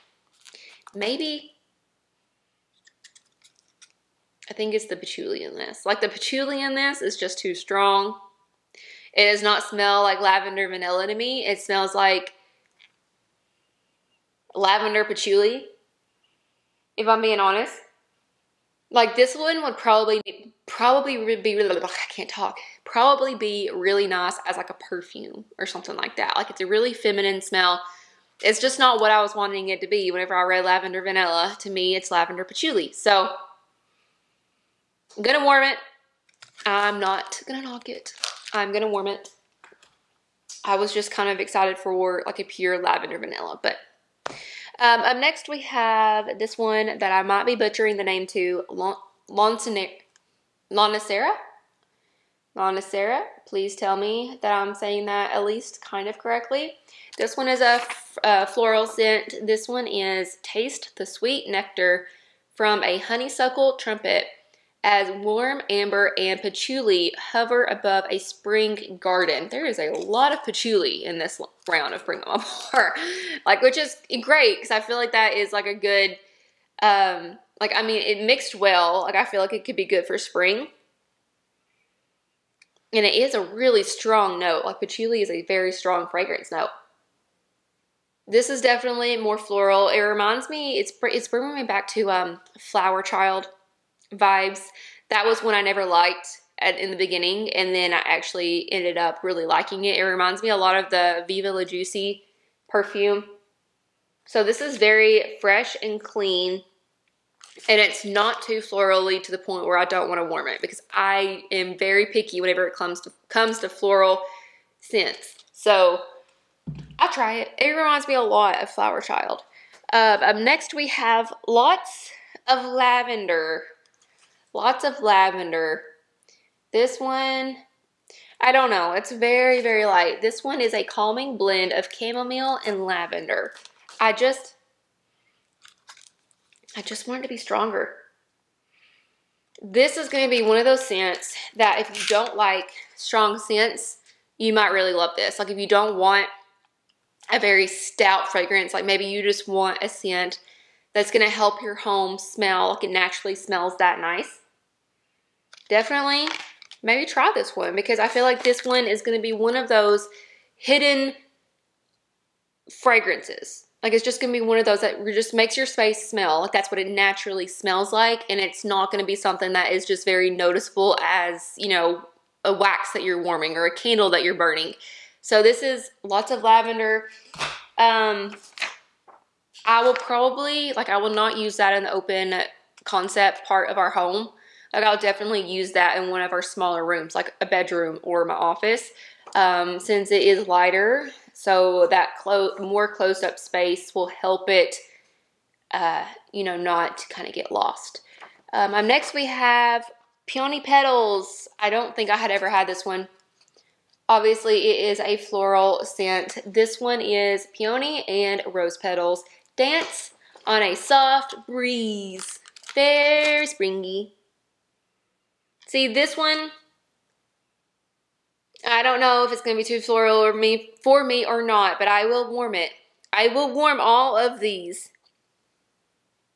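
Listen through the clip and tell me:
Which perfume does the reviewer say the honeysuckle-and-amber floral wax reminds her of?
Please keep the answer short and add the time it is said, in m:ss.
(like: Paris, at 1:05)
Viva La Juicy, at 1:41.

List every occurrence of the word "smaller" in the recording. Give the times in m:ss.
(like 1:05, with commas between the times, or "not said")
3:06.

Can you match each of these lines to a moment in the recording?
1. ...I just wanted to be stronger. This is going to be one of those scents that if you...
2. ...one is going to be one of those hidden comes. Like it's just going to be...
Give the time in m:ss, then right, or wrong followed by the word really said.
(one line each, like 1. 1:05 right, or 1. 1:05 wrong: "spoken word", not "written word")
1. 2:16 right
2. 2:38 wrong: "fragrances", not "comes".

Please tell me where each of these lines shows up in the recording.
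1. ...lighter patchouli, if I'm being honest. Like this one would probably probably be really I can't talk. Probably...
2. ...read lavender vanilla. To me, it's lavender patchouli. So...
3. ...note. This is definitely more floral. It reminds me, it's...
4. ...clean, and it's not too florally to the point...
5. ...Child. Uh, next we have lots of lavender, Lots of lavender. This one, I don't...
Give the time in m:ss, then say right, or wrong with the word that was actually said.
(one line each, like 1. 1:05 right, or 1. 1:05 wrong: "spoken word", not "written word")
1. 0:14 wrong: "lavender", not "lighter"
2. 0:30 right
3. 1:26 right
4. 1:46 right
5. 1:58 right.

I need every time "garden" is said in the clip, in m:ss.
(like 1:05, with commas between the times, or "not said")
1:08.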